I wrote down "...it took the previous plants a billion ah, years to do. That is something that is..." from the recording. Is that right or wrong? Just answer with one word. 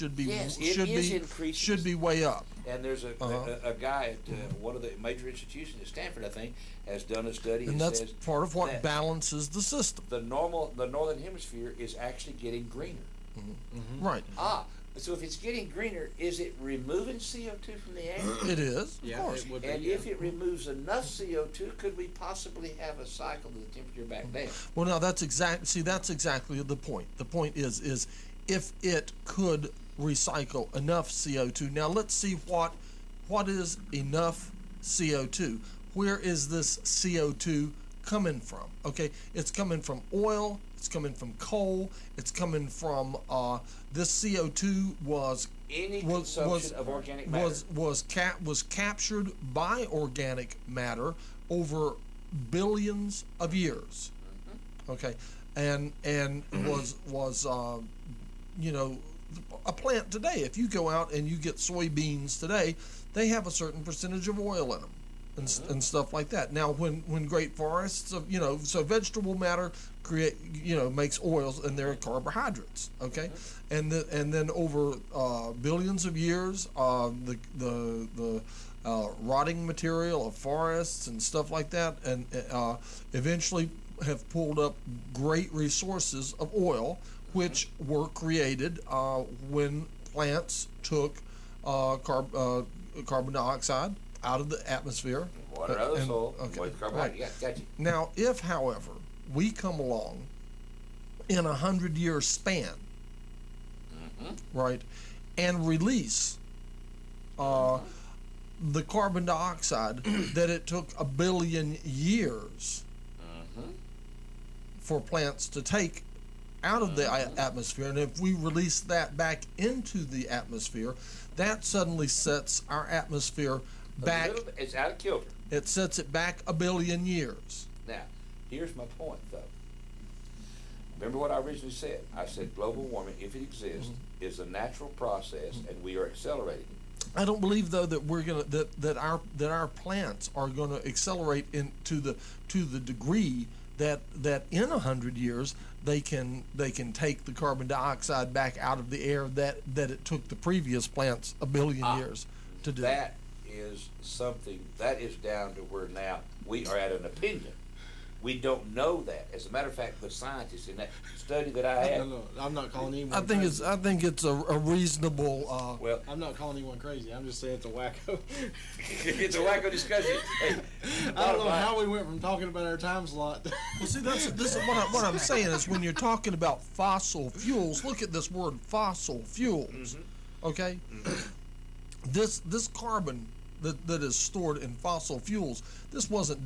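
right.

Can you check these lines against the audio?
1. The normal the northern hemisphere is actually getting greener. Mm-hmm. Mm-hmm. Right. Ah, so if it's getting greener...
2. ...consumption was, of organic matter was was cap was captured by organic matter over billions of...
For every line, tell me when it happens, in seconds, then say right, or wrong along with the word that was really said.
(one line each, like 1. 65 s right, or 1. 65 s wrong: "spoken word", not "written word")
1. 10 s right
2. 46 s right.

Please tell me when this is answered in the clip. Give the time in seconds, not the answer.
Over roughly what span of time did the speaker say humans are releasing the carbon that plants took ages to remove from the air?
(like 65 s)
101 s.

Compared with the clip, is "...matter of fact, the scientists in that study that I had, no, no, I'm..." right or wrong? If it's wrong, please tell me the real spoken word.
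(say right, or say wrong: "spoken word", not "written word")
right.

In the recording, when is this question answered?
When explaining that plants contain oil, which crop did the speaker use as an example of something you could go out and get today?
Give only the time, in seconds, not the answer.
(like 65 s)
61 s.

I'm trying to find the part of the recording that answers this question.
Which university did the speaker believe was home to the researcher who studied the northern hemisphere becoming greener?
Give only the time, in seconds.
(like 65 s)
5 s.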